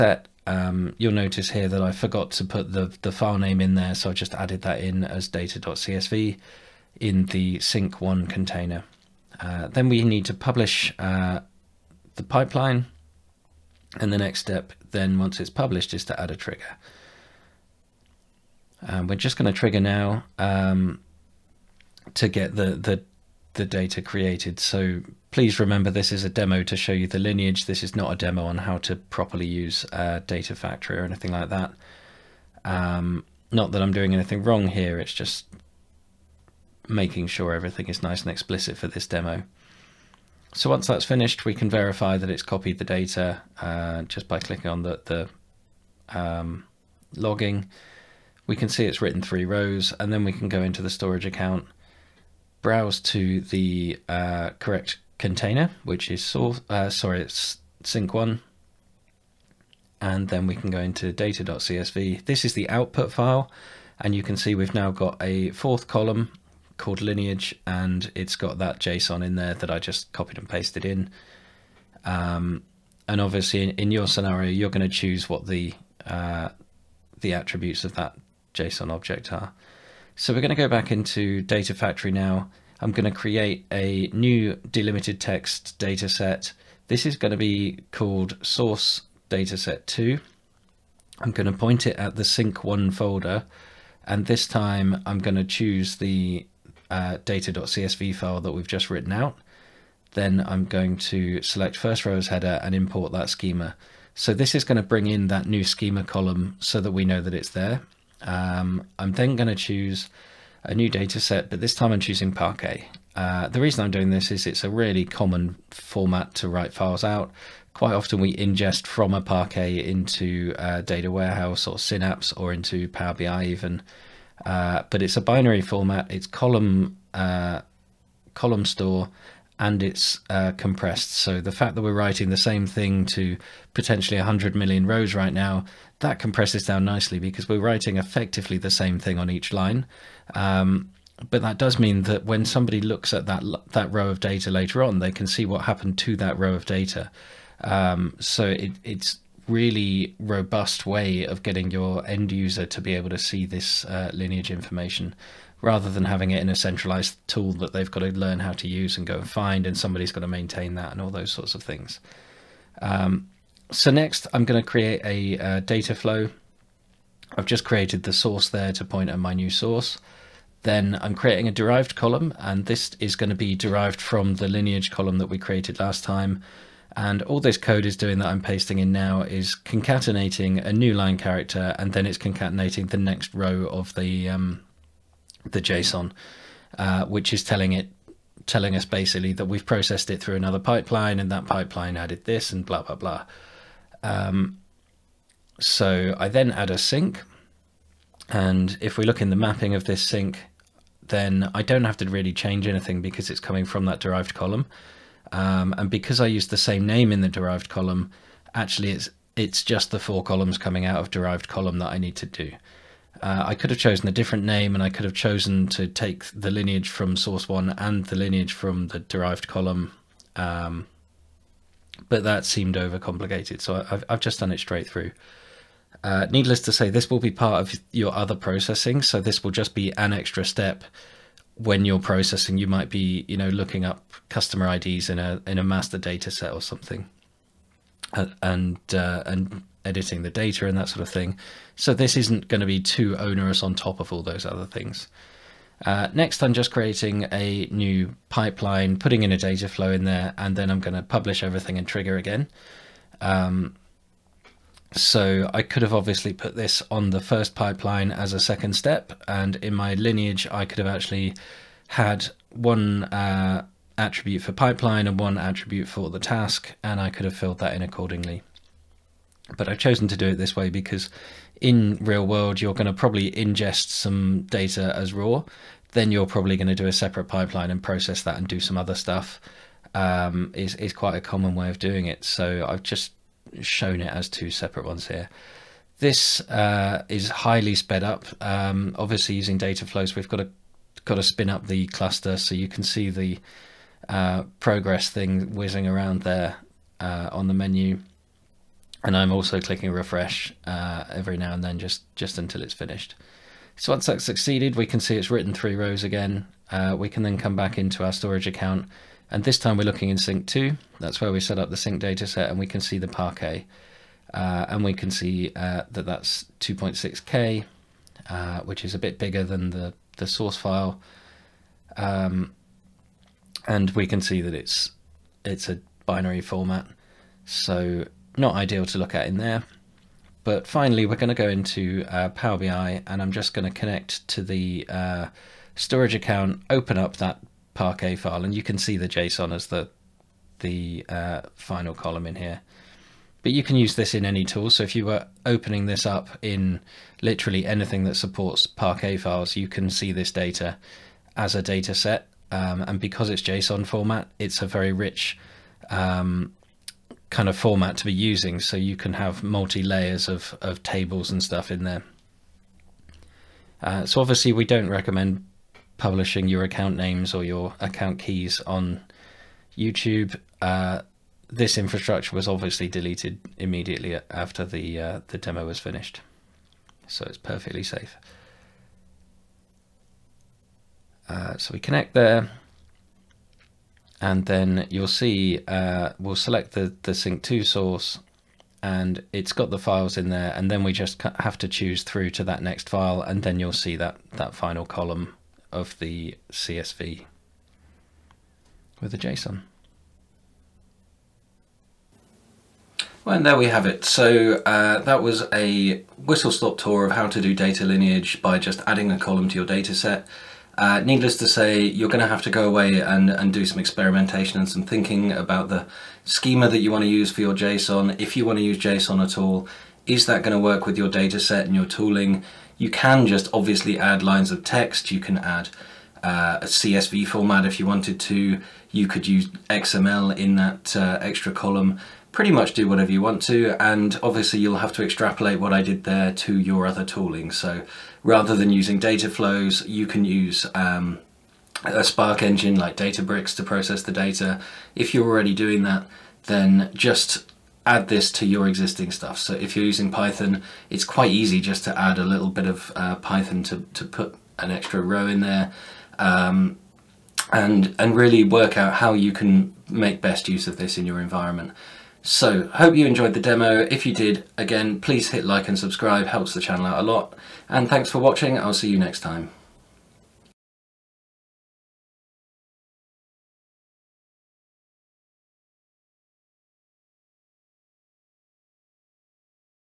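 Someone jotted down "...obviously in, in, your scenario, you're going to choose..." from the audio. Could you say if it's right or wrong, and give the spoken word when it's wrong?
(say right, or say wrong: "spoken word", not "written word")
right.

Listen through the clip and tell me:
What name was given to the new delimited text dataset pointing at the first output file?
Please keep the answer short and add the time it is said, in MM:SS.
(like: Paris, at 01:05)
source dataset 2, at 01:28.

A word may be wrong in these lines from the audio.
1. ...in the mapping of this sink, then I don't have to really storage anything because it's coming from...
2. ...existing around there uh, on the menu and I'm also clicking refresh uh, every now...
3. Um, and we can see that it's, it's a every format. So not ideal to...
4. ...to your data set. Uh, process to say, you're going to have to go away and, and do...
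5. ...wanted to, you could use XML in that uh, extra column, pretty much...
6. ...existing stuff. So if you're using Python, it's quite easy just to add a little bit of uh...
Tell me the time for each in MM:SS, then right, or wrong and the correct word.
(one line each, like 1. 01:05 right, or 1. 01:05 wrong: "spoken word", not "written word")
1. 03:19 wrong: "change", not "storage"
2. 04:55 wrong: "whizzing", not "existing"
3. 05:21 wrong: "binary", not "every"
4. 06:49 wrong: "needless", not "process"
5. 07:07 right
6. 07:28 right.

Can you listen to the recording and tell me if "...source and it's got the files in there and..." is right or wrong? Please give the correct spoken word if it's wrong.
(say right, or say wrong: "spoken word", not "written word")
right.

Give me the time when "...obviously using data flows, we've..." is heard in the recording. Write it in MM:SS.
04:48.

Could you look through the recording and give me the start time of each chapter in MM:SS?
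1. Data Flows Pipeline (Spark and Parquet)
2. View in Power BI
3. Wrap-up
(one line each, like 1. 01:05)
1. 01:08
2. 05:27
3. 06:41.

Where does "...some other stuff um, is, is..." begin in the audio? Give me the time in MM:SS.
04:38.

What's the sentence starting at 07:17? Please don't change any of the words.
So rather than using data flows, you can use um, a Spark engine like Databricks to process the data.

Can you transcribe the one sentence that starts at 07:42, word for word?
So, hope you enjoyed the demo.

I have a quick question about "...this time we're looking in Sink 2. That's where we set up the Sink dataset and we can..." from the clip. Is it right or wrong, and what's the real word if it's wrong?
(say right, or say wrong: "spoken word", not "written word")
right.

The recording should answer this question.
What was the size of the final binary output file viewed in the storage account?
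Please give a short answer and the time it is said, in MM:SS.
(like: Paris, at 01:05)
2.6K, at 05:16.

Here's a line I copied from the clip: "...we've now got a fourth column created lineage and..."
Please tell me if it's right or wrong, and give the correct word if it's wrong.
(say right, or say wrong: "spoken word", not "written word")
wrong: "called", not "created".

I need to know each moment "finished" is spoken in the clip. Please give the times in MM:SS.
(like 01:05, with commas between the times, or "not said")
00:41, 05:02, 06:15.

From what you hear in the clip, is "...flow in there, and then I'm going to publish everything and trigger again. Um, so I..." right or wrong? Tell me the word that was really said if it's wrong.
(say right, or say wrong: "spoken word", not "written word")
right.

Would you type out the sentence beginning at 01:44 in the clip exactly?
So this is going to bring in that new schema column so that we know that it's there.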